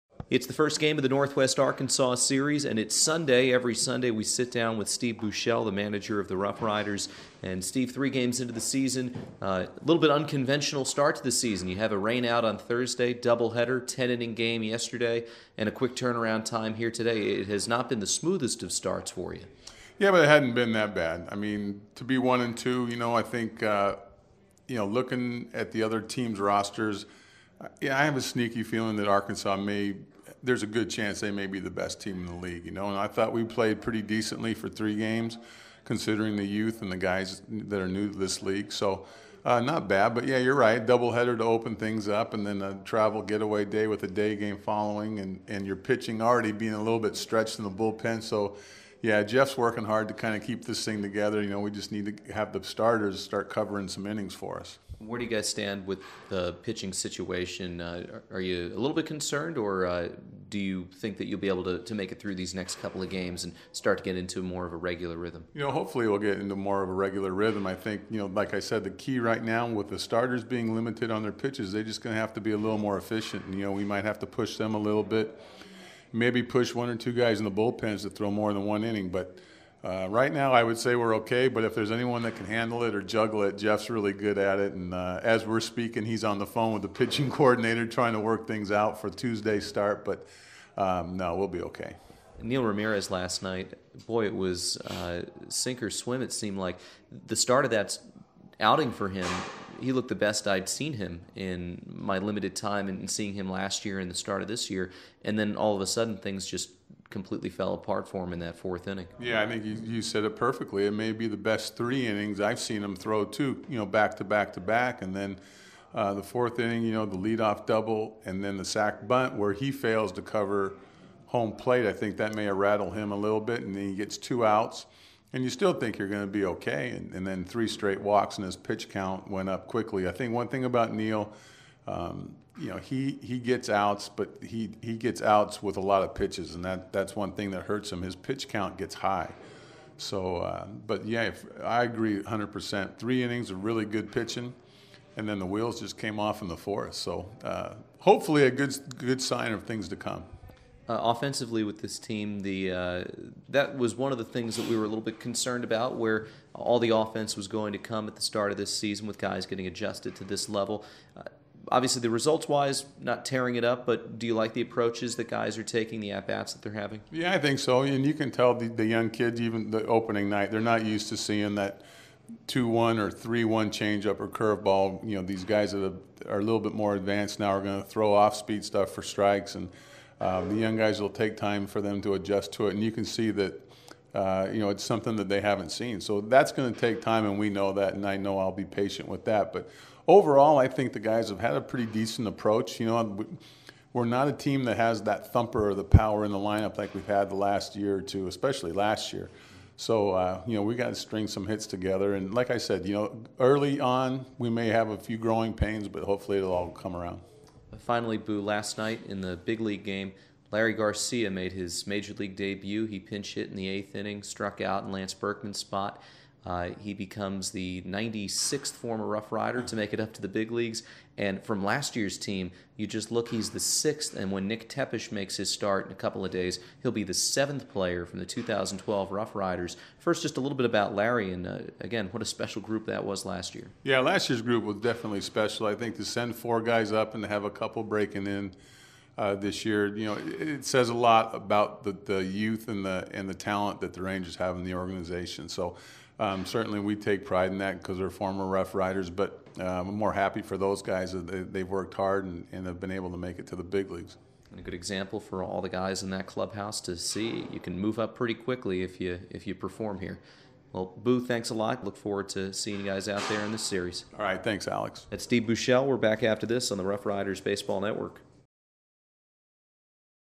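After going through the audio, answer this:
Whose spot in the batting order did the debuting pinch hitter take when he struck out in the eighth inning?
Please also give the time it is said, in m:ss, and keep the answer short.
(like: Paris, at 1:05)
Lance Berkman, at 3:34.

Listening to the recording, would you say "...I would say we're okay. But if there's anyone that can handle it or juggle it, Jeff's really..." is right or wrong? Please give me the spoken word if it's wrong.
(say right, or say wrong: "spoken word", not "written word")
right.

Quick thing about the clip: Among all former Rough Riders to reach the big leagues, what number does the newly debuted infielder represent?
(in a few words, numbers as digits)
96th.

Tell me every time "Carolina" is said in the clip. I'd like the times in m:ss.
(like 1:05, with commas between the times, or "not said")
not said.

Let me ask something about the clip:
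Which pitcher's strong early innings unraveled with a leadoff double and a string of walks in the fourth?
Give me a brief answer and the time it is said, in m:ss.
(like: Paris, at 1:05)
Neil Ramirez, at 1:32.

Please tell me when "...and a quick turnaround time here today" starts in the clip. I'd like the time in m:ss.
0:15.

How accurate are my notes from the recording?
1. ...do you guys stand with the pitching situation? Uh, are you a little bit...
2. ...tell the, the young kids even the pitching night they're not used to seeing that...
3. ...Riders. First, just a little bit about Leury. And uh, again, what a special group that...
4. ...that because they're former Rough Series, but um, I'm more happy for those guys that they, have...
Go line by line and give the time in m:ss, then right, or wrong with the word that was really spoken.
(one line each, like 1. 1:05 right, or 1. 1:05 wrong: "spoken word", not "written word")
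1. 0:55 right
2. 2:48 wrong: "opening", not "pitching"
3. 3:49 right
4. 4:07 wrong: "Riders", not "Series".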